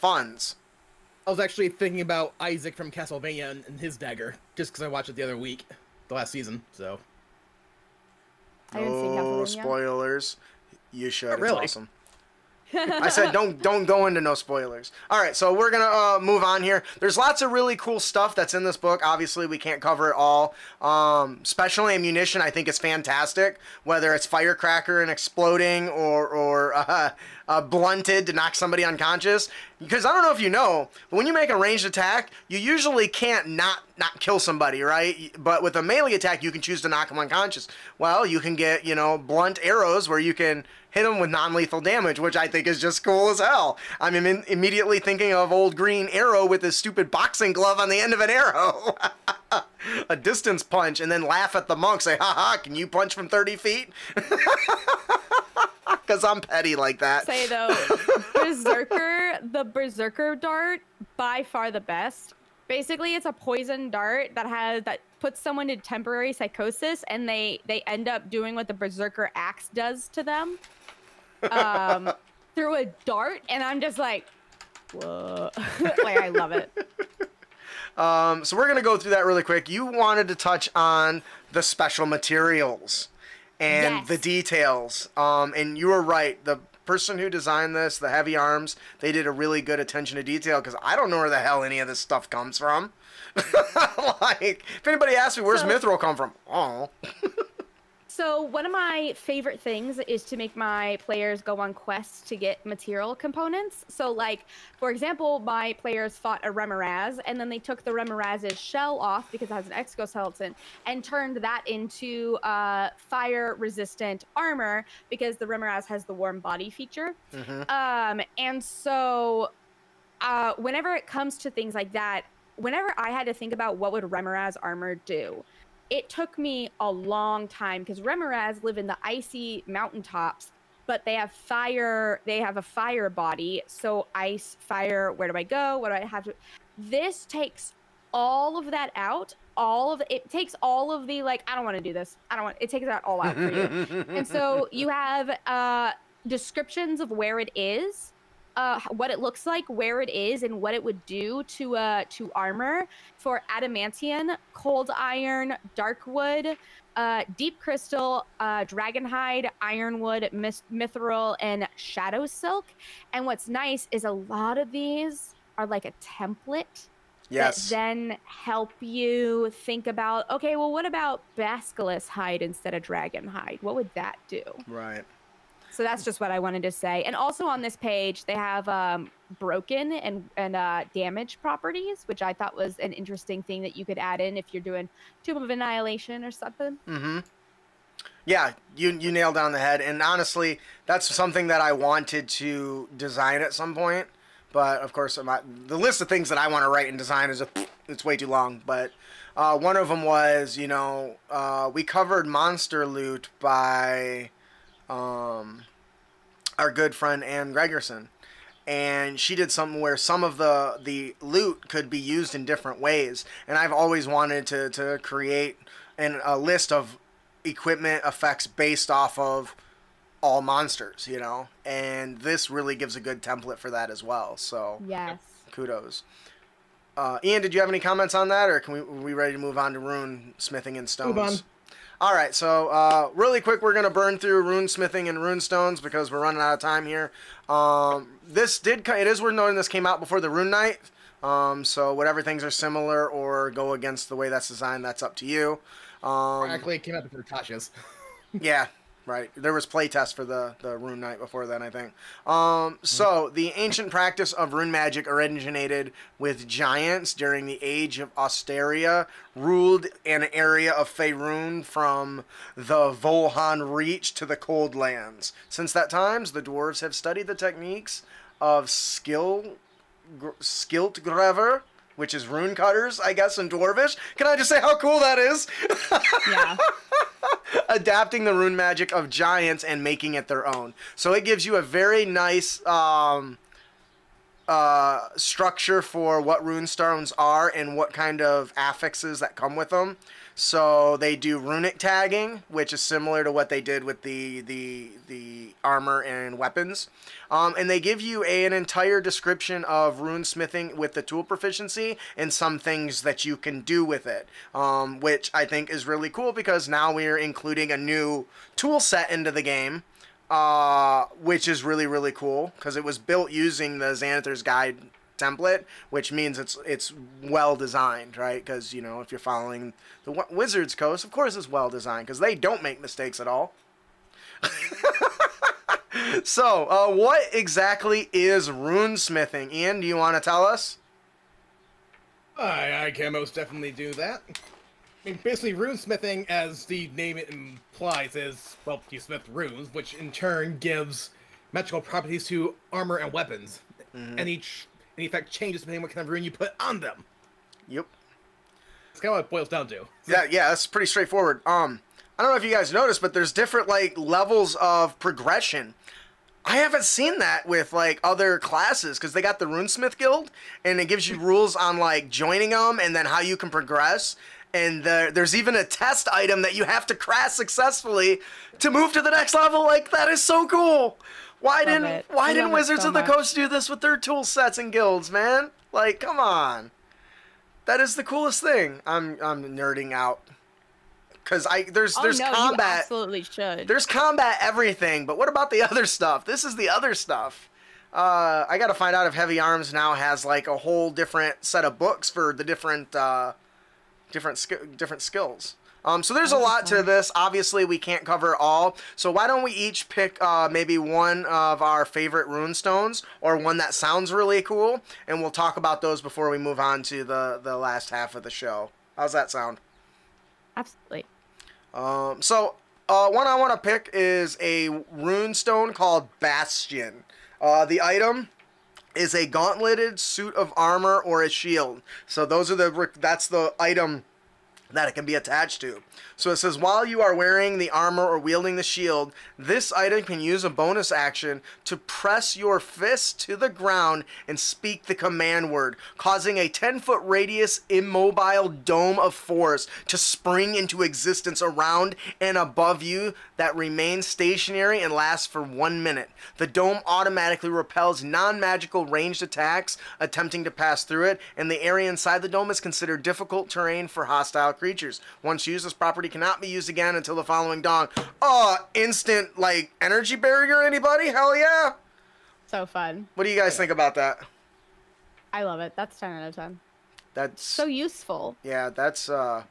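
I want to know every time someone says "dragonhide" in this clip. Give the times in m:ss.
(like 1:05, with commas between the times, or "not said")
2:38, 2:52.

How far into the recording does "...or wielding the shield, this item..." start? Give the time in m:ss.
7:08.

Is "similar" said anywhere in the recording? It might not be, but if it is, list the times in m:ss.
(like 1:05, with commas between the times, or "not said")
4:02, 4:52.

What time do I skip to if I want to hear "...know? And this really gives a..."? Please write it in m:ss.
3:41.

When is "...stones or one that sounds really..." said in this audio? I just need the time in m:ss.
6:42.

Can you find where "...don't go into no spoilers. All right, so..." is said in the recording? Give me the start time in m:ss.
0:13.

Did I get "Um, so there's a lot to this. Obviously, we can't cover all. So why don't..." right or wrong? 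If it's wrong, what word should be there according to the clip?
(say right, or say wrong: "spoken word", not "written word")
right.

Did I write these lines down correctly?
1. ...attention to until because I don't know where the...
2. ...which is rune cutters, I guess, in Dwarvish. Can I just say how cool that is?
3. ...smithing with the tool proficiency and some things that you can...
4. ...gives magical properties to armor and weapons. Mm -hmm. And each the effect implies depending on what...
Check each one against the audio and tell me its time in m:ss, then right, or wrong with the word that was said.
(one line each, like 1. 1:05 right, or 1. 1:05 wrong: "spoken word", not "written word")
1. 1:29 wrong: "detail", not "until"
2. 4:32 right
3. 5:00 right
4. 5:40 wrong: "changes", not "implies".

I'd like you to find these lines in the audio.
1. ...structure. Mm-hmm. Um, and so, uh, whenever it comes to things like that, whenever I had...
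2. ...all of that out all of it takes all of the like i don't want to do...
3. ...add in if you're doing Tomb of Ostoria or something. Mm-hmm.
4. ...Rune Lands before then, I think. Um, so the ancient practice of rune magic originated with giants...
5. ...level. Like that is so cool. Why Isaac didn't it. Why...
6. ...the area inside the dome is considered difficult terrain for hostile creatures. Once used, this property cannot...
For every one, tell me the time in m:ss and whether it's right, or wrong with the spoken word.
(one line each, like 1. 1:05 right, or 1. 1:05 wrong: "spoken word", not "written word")
1. 1:56 wrong: "feature", not "structure"
2. 2:18 right
3. 3:03 wrong: "Annihilation", not "Ostoria"
4. 4:10 wrong: "Knight", not "Lands"
5. 6:09 wrong: "Love", not "Isaac"
6. 7:31 right.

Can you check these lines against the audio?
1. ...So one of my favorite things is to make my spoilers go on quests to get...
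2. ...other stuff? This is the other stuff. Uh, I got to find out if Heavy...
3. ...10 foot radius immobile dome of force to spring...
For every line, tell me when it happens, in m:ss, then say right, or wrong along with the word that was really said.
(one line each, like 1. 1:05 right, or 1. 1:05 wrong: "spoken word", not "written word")
1. 1:38 wrong: "players", not "spoilers"
2. 6:25 right
3. 7:16 right.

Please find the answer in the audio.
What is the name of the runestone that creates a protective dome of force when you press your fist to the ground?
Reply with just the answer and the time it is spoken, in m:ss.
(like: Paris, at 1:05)
Bastion, at 6:56.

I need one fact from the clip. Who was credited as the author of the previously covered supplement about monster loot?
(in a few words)
Ann Gregerson.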